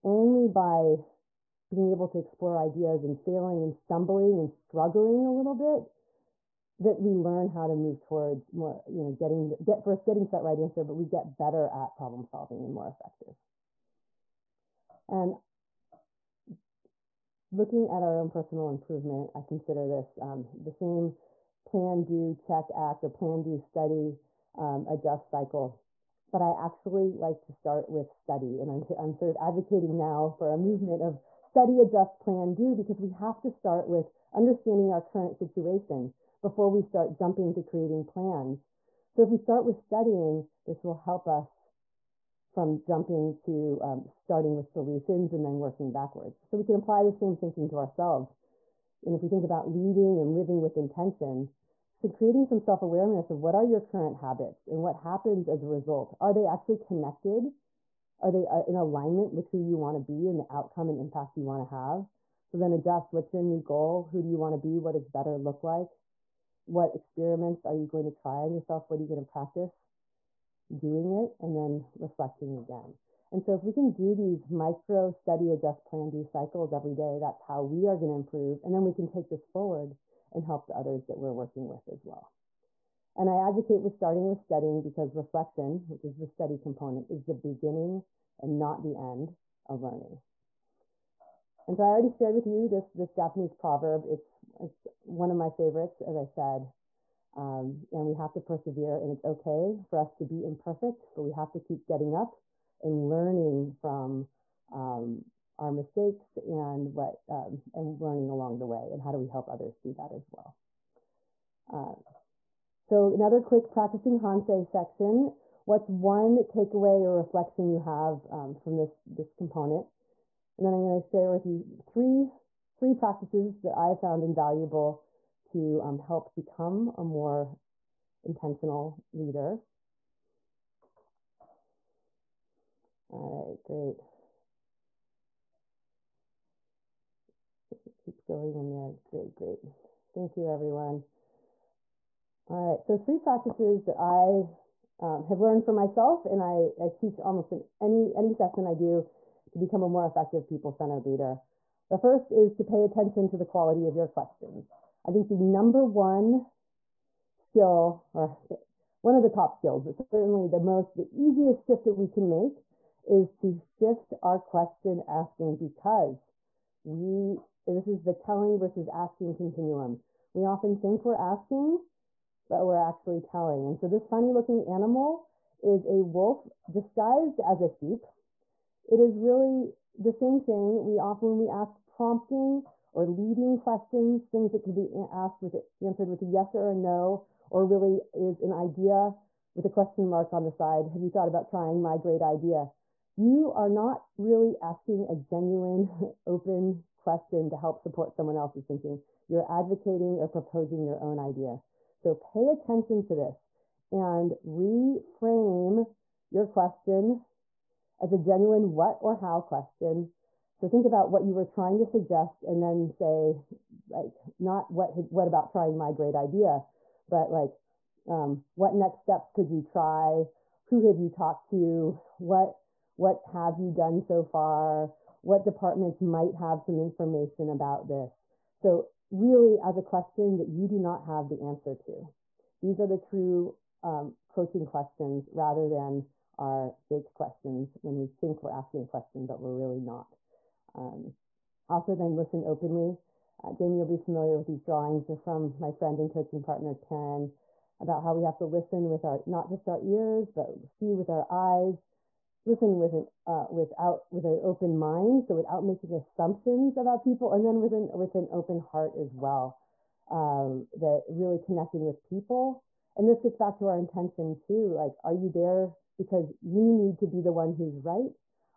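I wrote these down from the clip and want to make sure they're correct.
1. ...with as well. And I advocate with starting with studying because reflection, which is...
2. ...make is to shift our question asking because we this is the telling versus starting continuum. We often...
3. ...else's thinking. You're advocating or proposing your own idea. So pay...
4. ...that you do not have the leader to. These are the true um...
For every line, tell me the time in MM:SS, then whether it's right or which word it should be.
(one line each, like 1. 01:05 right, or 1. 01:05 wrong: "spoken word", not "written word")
1. 01:21 right
2. 02:42 wrong: "asking", not "starting"
3. 03:18 right
4. 03:50 wrong: "answer", not "leader".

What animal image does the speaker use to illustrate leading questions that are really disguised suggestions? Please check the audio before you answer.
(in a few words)
a wolf disguised as a sheep.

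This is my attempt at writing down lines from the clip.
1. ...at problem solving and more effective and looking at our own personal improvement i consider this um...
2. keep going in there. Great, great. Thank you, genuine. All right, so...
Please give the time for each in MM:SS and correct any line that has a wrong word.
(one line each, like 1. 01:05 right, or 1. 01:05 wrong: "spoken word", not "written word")
1. 00:11 right
2. 02:18 wrong: "everyone", not "genuine".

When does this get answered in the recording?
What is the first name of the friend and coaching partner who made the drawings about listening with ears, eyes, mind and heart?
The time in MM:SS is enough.
04:06.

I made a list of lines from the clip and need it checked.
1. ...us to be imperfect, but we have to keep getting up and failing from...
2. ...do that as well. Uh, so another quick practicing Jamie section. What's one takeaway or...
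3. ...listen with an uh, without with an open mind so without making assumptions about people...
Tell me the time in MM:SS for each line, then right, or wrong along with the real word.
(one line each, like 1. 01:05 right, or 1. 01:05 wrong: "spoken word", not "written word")
1. 01:39 wrong: "learning", not "failing"
2. 01:49 wrong: "Hansei", not "Jamie"
3. 04:12 right.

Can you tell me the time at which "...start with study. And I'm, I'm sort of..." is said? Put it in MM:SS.
00:27.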